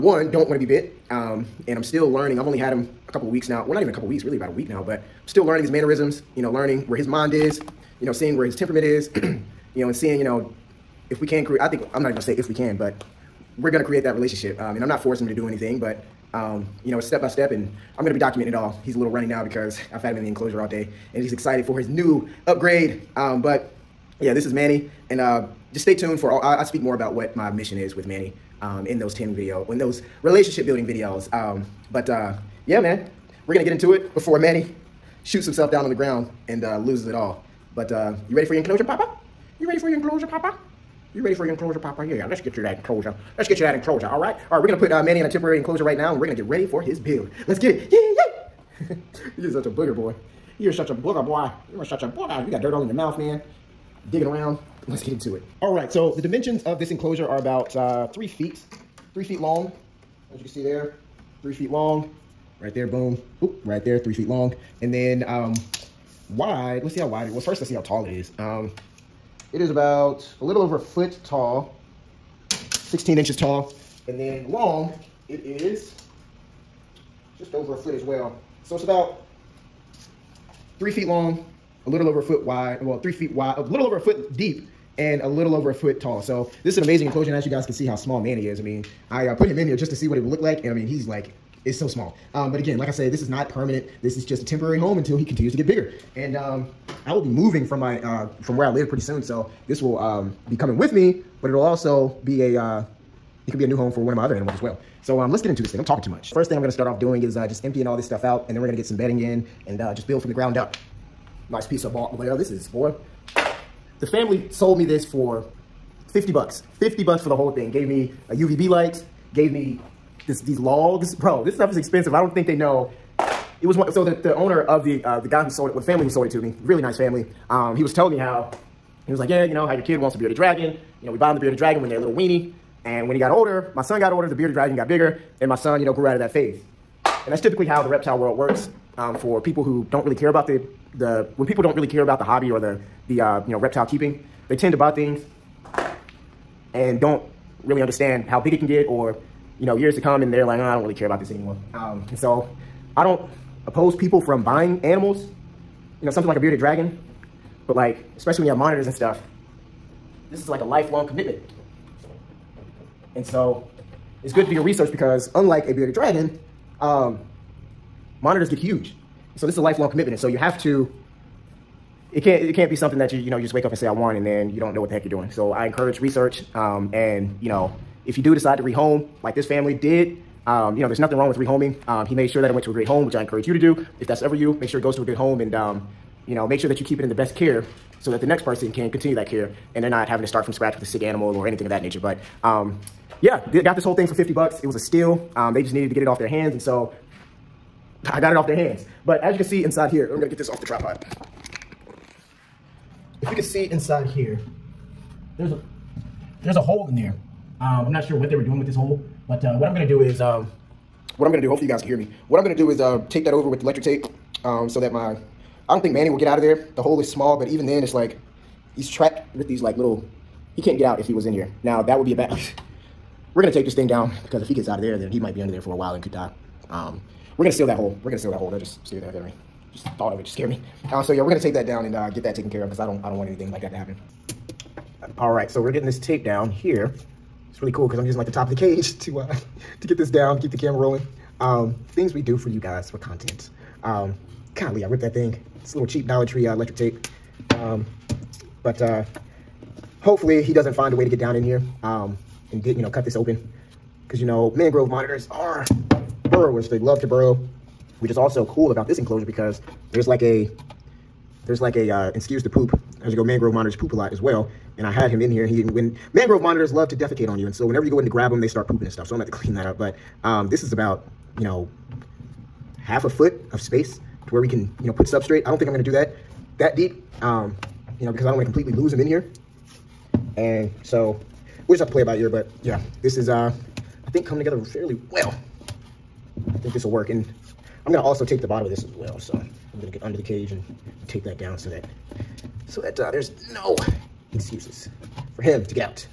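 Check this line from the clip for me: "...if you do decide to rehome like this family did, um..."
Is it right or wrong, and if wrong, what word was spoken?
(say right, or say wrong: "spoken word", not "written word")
right.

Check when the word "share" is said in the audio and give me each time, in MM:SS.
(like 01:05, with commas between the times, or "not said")
not said.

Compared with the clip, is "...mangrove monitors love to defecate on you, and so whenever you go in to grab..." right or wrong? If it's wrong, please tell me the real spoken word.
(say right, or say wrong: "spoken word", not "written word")
right.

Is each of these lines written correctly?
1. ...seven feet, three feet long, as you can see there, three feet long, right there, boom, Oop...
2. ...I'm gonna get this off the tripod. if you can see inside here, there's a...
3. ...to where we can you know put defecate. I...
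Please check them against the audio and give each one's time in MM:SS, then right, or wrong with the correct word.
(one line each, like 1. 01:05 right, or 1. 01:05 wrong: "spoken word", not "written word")
1. 00:58 wrong: "three", not "seven"
2. 03:20 right
3. 04:34 wrong: "substrate", not "defecate".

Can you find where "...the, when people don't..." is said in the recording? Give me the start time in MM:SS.
02:20.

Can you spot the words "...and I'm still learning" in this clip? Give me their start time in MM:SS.
00:01.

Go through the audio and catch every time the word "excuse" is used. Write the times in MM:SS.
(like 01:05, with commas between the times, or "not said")
04:22, 04:54.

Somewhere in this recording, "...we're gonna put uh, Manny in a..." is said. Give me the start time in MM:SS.
00:44.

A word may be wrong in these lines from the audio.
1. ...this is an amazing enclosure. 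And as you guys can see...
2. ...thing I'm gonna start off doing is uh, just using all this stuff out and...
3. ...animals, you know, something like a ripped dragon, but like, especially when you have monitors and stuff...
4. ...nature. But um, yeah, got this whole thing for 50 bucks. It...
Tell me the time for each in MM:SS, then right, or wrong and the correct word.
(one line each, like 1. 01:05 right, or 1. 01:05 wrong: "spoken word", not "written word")
1. 01:26 right
2. 01:46 wrong: "emptying", not "using"
3. 02:34 wrong: "bearded", not "ripped"
4. 03:11 right.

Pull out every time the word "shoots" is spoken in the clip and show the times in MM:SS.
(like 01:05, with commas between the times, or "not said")
00:35.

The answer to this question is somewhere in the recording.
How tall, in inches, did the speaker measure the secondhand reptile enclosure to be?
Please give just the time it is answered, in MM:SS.
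01:12.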